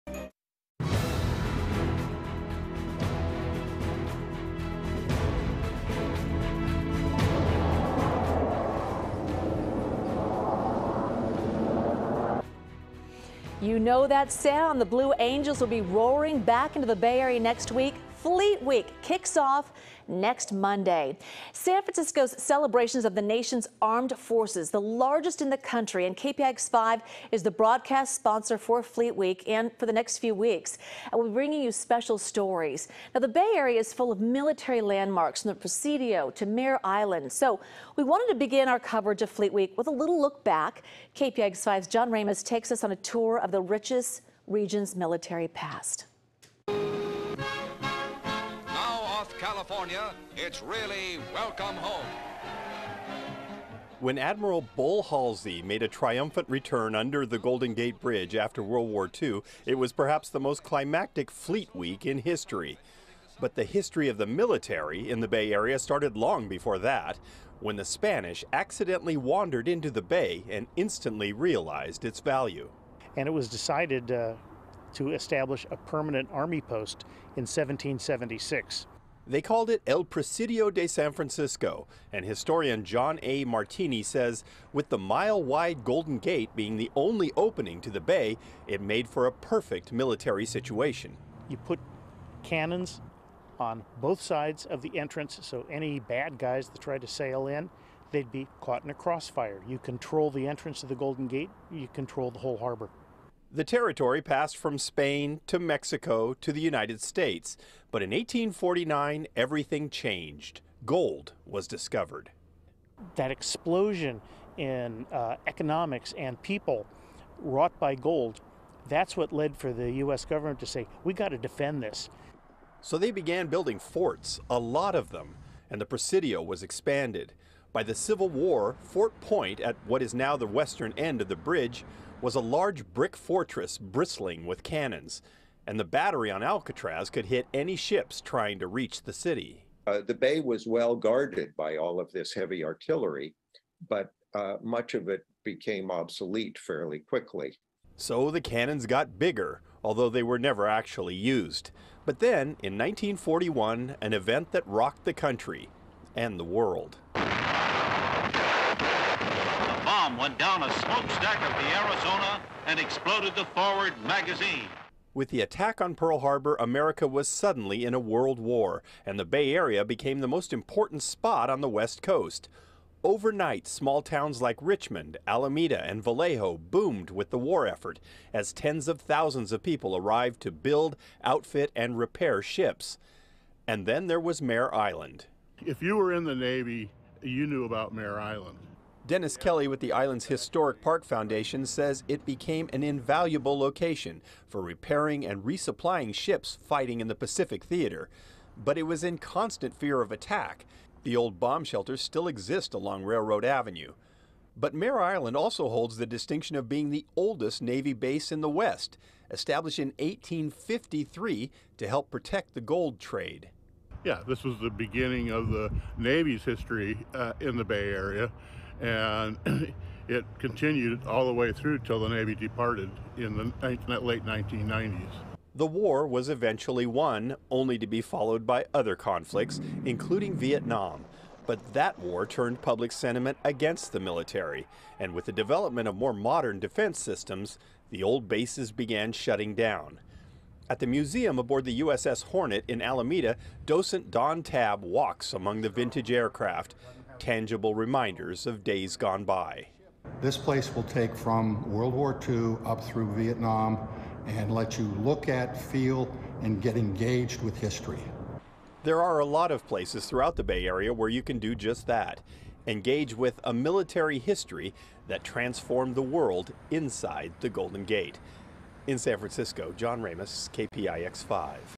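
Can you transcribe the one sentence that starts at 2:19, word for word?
Uh, the bay was well guarded by all of this heavy artillery, but uh, much of it became obsolete fairly quickly.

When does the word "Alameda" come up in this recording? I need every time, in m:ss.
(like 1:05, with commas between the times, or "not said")
2:55, 4:02.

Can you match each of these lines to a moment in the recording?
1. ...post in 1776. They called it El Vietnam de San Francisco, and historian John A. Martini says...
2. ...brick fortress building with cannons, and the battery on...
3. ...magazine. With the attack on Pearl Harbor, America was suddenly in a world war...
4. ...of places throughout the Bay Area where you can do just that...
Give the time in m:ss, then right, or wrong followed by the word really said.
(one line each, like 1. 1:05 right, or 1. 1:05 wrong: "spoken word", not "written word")
1. 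1:16 wrong: "Presidio", not "Vietnam"
2. 2:12 wrong: "bristling", not "building"
3. 2:44 right
4. 4:19 right.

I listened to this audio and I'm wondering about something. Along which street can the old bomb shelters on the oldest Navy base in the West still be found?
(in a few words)
Railroad Avenue.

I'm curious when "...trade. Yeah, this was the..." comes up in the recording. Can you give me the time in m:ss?
3:32.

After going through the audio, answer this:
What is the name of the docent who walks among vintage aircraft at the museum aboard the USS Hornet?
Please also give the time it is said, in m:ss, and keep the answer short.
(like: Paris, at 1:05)
Don Tabb, at 4:04.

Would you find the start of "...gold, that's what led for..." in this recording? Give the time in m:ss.
1:57.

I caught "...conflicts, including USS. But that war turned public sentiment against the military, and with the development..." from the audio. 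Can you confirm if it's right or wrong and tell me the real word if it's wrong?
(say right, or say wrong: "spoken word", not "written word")
wrong: "Vietnam", not "USS".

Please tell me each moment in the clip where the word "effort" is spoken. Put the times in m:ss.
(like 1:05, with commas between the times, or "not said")
2:57.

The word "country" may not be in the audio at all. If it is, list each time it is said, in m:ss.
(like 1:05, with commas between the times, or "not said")
0:25, 2:35.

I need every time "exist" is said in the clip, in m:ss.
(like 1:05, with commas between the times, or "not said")
3:22.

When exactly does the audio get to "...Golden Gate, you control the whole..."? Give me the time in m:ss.
1:40.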